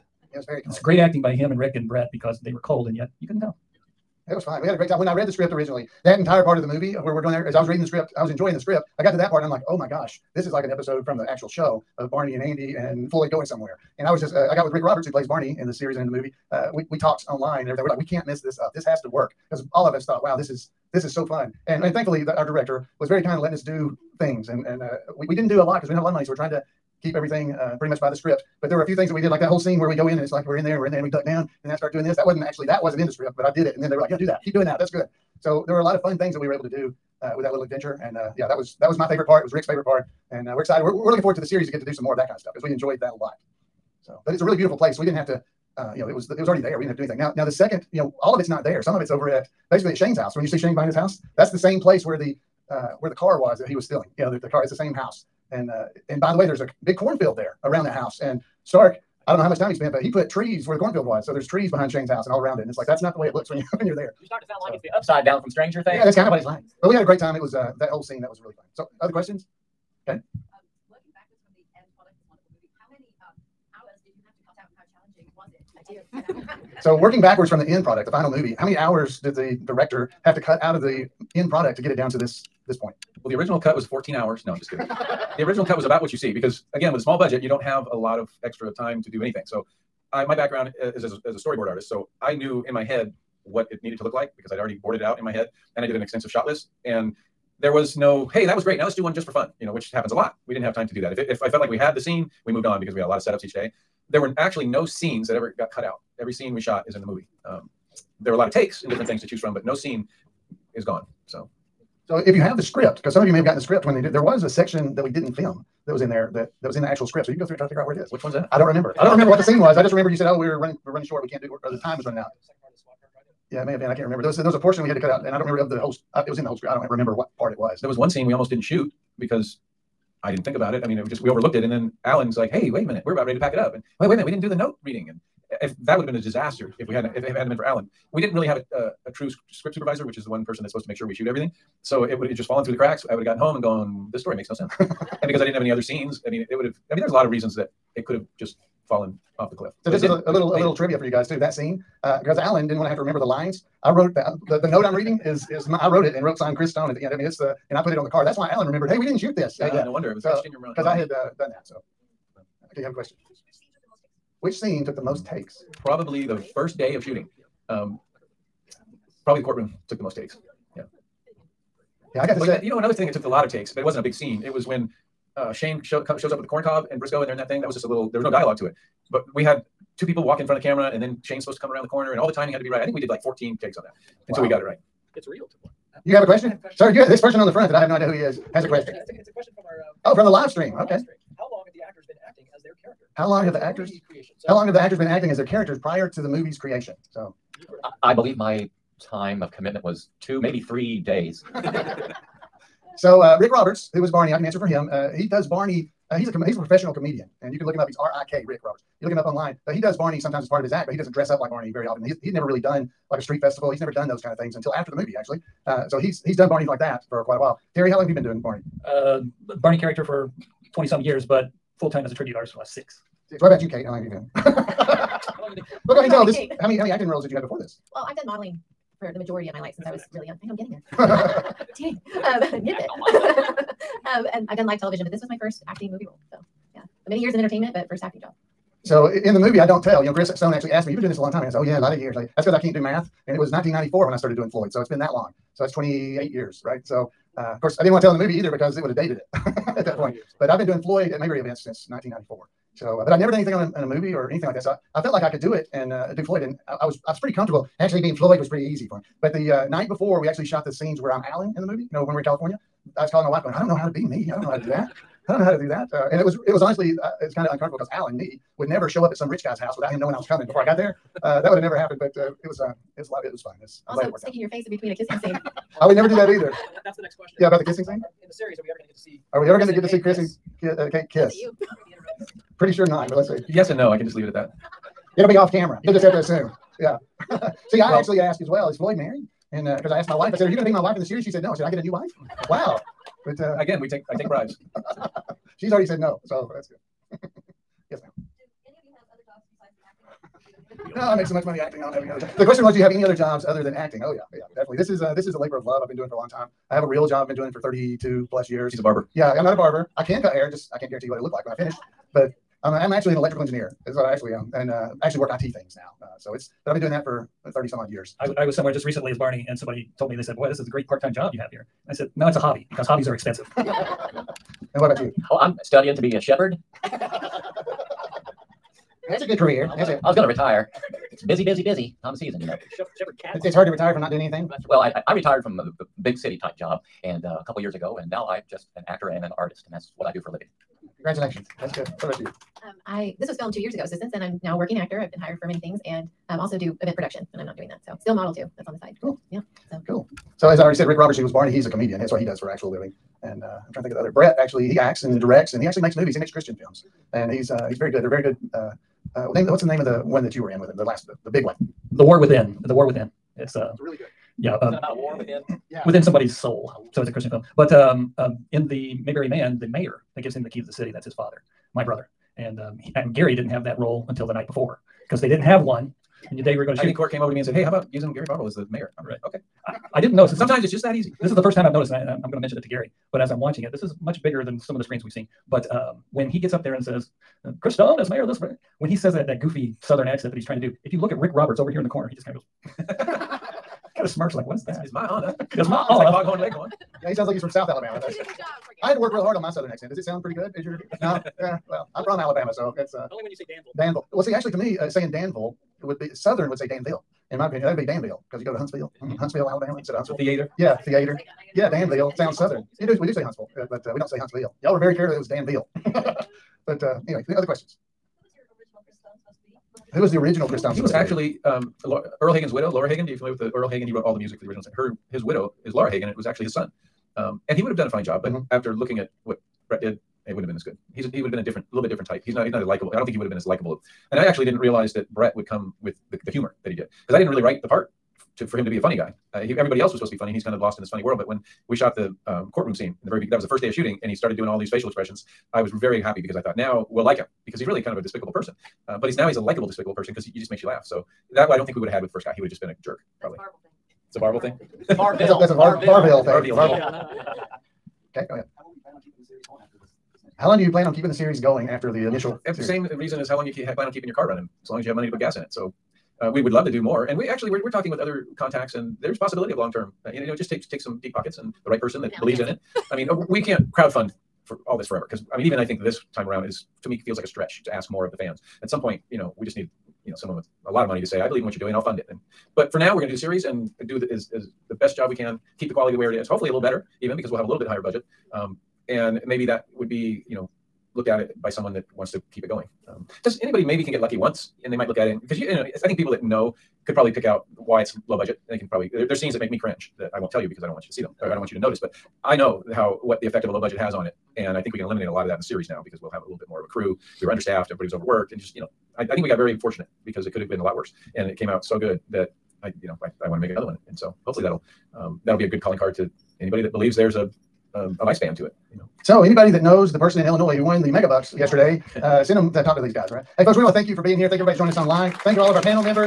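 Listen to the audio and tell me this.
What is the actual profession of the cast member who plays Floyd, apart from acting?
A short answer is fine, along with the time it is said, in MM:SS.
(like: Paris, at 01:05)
Electrical engineer, at 05:13.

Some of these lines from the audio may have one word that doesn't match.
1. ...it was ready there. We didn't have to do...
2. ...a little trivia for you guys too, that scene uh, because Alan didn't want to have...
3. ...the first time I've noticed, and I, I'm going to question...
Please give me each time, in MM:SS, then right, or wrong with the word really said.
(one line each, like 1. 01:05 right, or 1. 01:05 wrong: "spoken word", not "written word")
1. 00:46 wrong: "already", not "ready"
2. 02:30 right
3. 06:21 wrong: "mention", not "question".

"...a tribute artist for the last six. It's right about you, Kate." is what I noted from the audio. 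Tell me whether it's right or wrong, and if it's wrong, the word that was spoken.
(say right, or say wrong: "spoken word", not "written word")
right.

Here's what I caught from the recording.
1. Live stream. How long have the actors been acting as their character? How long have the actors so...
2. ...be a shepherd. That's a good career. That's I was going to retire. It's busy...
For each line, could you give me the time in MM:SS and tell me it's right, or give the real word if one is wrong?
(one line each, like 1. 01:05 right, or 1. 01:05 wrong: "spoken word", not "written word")
1. 03:10 right
2. 05:25 right.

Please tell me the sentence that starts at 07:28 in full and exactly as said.
Uh, but he's now he's a likable, despicable person because he, he, just makes you laugh.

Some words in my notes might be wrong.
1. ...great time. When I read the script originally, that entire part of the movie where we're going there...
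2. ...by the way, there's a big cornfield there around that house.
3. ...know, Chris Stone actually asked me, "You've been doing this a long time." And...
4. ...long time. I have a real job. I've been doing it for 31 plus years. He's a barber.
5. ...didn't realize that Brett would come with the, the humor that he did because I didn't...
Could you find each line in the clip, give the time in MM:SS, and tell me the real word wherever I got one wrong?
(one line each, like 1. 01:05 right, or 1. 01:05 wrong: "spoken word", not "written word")
1. 00:04 right
2. 00:56 right
3. 04:00 right
4. 05:06 wrong: "32", not "31"
5. 07:14 right.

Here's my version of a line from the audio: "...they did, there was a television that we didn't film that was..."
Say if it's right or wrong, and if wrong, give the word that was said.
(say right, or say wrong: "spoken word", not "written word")
wrong: "section", not "television".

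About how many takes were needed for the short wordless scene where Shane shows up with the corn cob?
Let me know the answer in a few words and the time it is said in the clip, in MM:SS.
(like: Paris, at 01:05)
14, at 03:03.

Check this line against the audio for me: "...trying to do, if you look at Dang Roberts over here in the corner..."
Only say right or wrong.
wrong.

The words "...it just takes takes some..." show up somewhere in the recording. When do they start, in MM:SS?
07:50.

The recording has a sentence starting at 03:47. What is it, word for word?
Well, I've done modeling for the majority of my life since That's I was next.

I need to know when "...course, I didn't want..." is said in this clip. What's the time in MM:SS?
04:07.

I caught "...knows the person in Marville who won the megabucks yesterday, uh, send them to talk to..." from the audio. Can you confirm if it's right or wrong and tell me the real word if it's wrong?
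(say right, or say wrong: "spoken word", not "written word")
wrong: "Illinois", not "Marville".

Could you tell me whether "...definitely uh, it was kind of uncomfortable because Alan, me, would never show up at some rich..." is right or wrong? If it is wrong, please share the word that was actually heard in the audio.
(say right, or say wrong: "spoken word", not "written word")
wrong: "honestly", not "definitely".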